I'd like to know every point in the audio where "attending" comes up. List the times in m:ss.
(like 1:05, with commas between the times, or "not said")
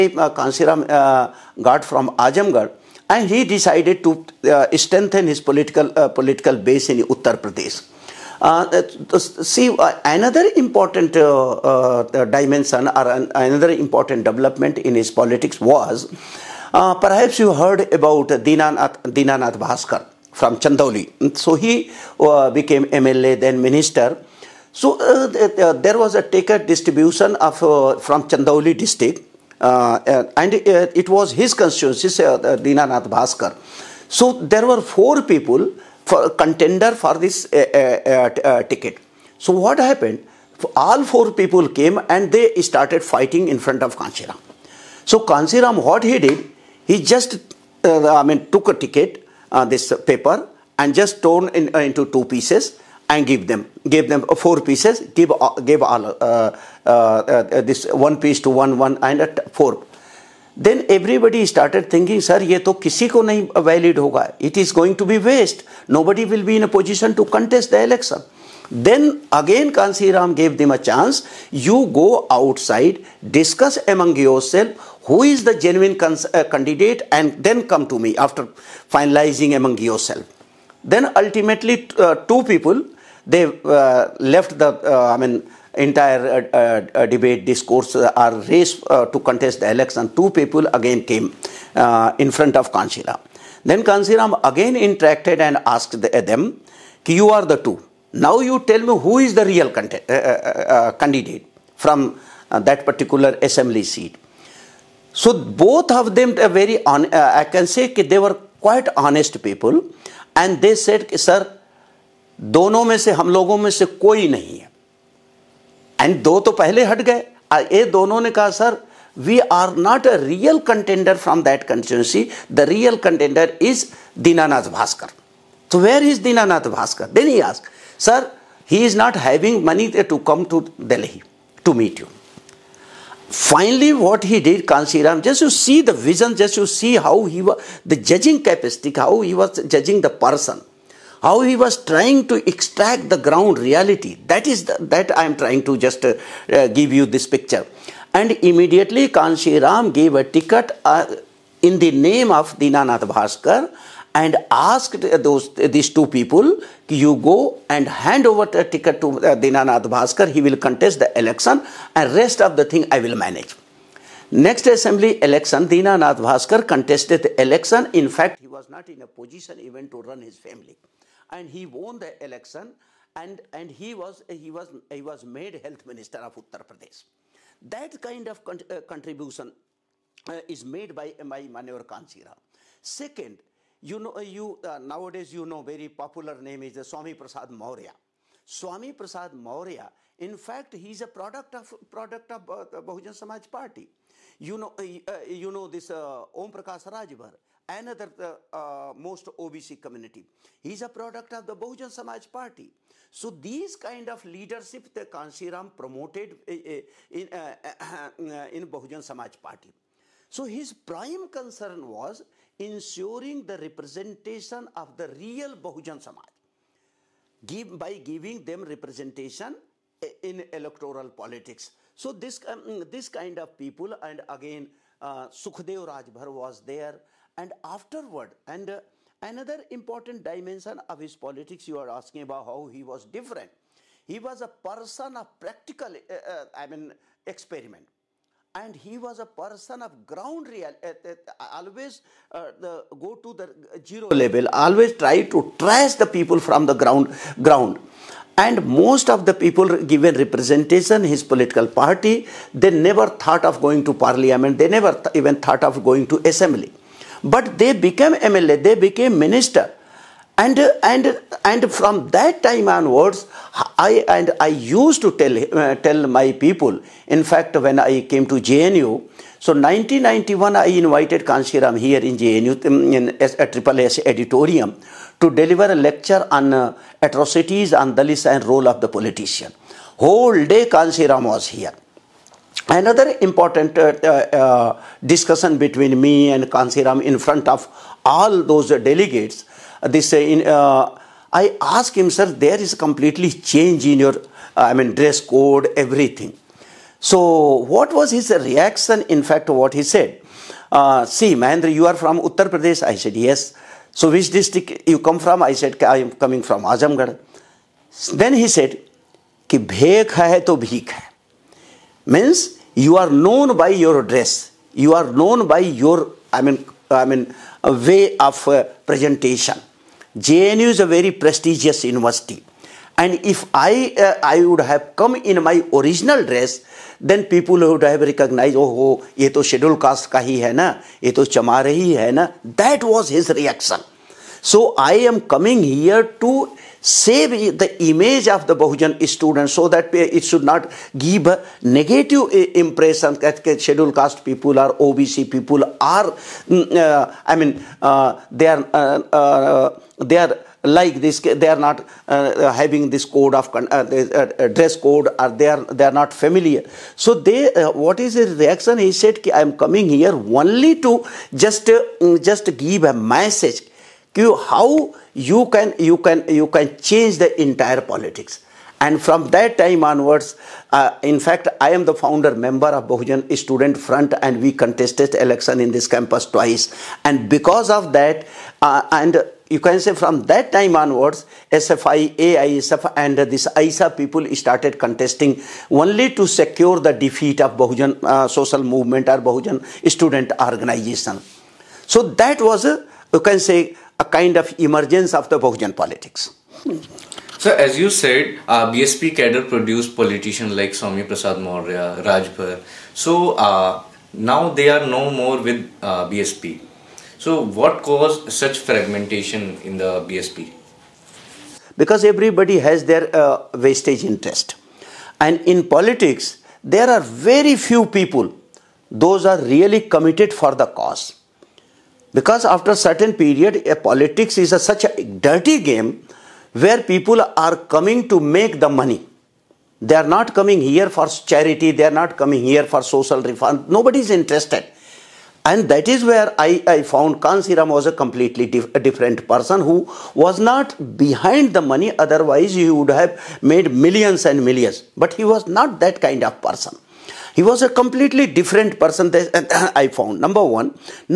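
not said.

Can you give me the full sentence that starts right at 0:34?
So there were four people for contender for this ticket.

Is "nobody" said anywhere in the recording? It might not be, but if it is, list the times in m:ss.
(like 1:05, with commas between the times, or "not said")
1:05, 7:13.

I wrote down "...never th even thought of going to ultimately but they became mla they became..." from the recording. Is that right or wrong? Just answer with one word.
wrong.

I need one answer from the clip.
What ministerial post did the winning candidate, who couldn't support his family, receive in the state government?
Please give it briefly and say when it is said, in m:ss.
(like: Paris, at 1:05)
Health minister, at 2:55.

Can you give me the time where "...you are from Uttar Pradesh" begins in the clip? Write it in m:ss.
5:01.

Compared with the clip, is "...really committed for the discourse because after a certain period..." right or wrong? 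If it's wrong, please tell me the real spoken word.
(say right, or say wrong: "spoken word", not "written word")
wrong: "cause", not "discourse".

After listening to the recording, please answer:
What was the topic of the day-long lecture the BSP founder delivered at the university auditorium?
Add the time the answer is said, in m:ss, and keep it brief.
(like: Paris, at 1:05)
Atrocities on Dalits, at 4:36.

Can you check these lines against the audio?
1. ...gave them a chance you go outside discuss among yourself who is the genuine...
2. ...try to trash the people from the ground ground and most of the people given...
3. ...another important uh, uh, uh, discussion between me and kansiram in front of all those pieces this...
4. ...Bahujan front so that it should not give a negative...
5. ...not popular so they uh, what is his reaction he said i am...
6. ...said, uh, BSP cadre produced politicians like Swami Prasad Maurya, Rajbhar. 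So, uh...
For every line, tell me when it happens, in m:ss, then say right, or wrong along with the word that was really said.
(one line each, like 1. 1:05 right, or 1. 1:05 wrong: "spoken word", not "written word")
1. 1:10 right
2. 4:04 right
3. 4:42 wrong: "delegates", not "pieces"
4. 5:38 wrong: "student", not "front"
5. 5:55 wrong: "familiar", not "popular"
6. 6:37 right.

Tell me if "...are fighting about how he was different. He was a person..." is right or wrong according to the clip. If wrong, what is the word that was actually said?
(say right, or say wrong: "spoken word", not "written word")
wrong: "asking", not "fighting".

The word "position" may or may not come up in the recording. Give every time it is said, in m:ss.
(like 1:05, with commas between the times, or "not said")
1:06, 2:49.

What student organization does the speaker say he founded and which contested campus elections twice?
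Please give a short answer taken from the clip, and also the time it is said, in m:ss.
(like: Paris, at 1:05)
Bahujan Student Front, at 6:12.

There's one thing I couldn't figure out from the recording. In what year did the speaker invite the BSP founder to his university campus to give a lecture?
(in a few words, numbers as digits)
1991.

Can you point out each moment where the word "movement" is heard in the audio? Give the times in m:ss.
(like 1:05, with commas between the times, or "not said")
6:28.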